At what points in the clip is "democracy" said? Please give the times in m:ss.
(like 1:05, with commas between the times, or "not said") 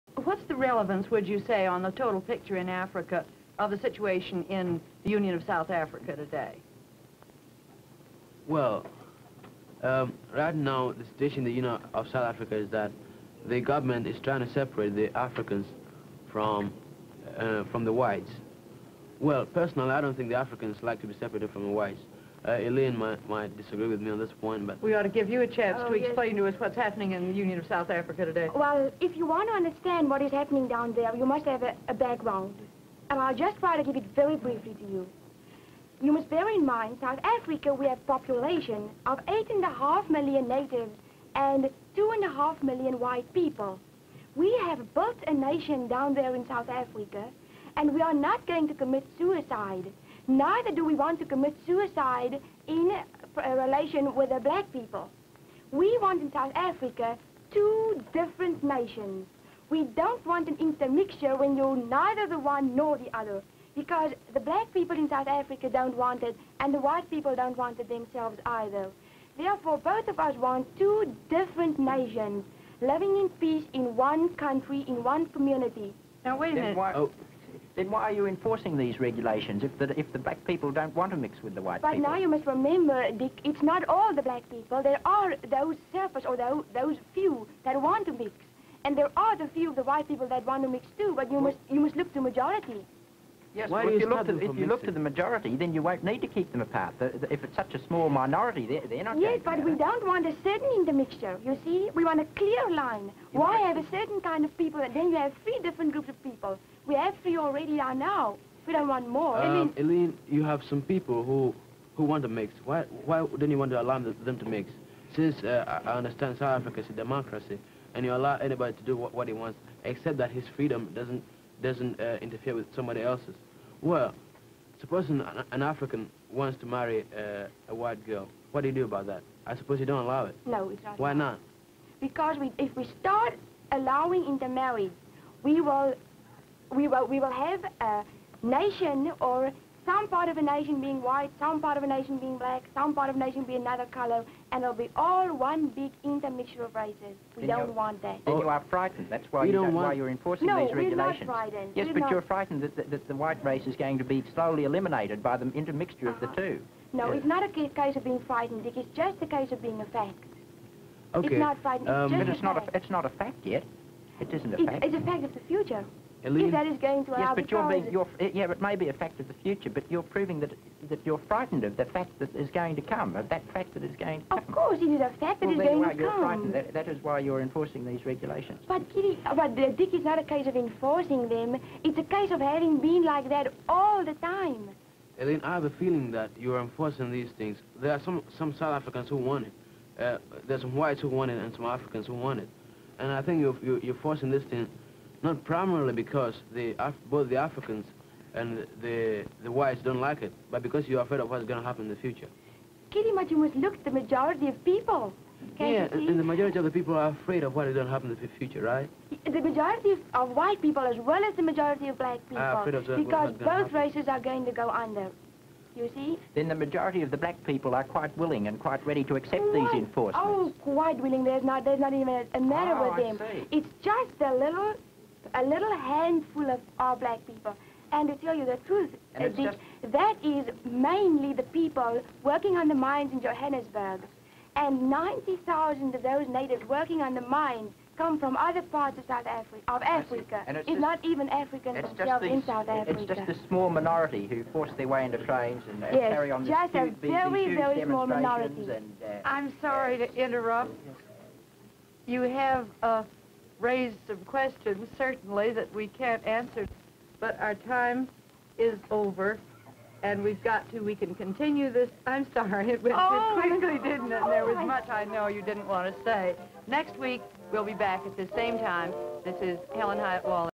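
1:56.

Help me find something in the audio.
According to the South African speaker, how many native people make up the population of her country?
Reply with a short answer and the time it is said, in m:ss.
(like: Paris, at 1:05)
8.5 million, at 0:39.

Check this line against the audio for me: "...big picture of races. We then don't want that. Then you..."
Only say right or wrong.
wrong.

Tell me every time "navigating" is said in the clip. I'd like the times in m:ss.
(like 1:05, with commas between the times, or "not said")
not said.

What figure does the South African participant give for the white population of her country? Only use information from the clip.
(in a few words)
2.5 million.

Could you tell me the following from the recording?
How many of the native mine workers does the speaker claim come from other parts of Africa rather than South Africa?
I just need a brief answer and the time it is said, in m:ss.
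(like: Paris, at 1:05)
90,000, at 3:54.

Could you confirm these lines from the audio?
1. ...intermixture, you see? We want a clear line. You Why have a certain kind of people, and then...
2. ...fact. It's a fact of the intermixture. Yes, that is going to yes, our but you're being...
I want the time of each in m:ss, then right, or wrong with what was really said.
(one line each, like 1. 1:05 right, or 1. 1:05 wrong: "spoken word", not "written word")
1. 1:40 right
2. 2:44 wrong: "future", not "intermixture".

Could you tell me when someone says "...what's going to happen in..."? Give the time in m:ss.
3:21.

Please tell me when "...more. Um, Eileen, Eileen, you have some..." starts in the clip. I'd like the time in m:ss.
1:49.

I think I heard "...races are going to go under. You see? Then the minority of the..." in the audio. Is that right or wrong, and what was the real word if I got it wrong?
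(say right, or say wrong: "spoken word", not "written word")
wrong: "majority", not "minority".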